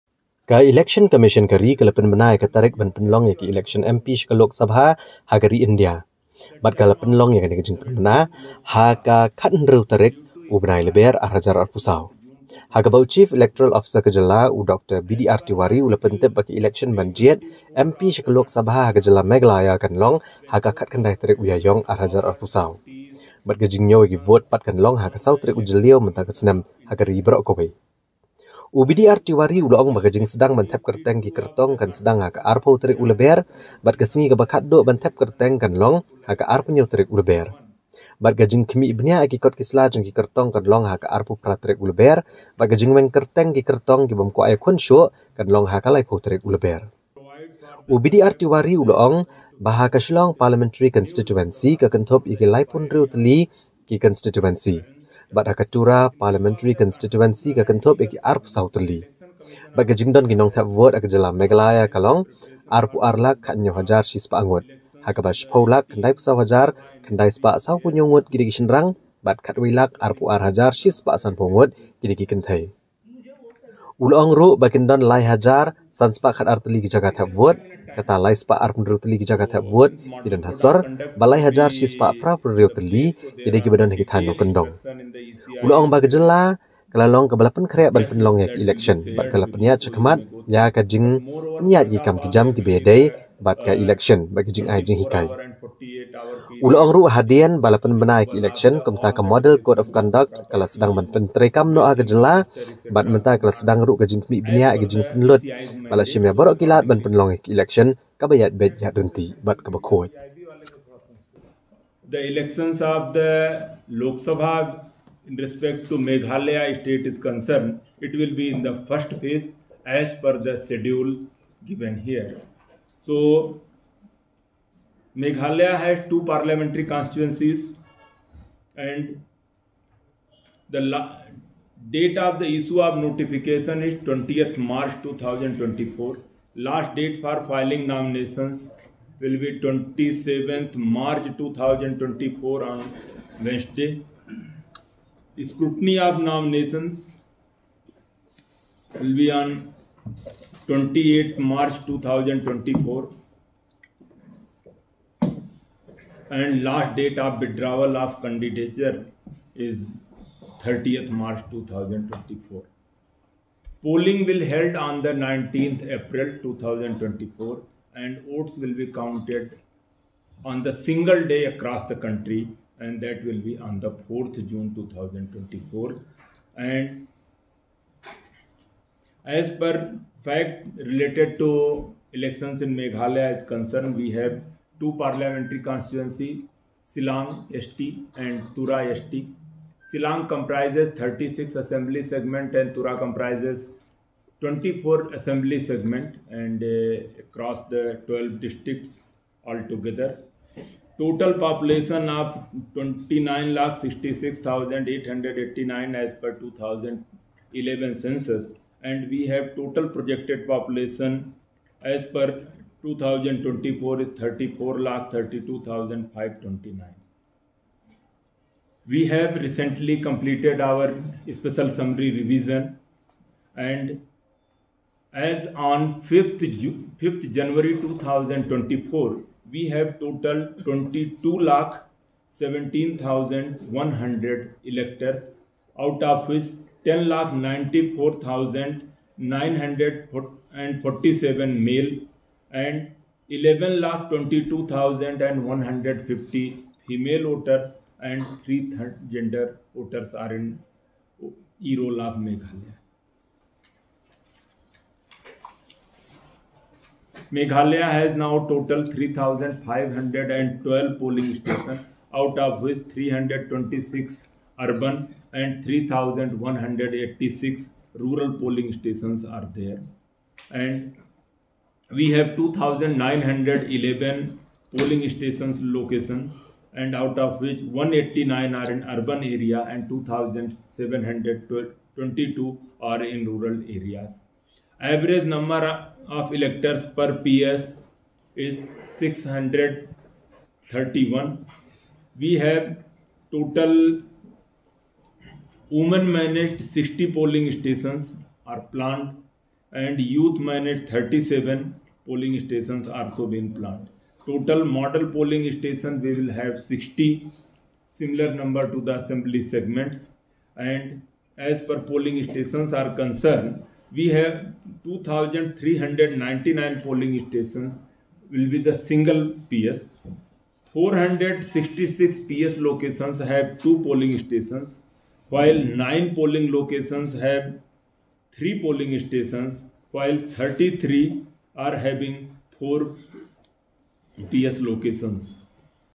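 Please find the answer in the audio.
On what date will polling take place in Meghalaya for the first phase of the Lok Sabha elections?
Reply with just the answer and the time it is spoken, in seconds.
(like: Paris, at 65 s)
19th April 2024, at 165 s.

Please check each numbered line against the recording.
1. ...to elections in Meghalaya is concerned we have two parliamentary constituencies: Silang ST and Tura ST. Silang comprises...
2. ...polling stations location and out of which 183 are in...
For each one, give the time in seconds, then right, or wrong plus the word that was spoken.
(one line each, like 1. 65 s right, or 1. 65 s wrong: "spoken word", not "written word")
1. 181 s right
2. 274 s wrong: "189", not "183".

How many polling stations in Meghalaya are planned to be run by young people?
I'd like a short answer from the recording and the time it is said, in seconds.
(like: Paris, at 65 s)
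37, at 300 s.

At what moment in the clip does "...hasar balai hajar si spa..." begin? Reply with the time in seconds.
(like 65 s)
80 s.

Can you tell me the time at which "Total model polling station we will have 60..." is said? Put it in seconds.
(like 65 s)
304 s.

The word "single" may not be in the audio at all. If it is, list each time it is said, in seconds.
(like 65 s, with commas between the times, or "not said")
170 s, 318 s.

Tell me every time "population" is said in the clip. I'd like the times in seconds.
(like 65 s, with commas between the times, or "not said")
201 s, 210 s.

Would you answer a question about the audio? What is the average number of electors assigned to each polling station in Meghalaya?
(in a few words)
631.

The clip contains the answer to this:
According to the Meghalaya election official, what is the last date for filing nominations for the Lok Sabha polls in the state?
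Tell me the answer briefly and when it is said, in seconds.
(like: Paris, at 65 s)
27th March 2024, at 139 s.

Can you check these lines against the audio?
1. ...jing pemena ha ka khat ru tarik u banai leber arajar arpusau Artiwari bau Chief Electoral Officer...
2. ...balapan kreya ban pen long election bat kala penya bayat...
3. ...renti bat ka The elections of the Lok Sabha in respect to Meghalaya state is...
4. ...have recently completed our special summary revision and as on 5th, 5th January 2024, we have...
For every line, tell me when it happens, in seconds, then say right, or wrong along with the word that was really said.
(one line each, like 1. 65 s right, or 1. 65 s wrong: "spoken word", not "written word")
1. 7 s wrong: "Haga", not "Artiwari"
2. 87 s wrong: "chakmat", not "bayat"
3. 108 s right
4. 219 s right.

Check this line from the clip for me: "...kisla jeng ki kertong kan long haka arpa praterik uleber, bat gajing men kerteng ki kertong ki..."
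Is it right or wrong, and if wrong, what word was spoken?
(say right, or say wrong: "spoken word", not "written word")
right.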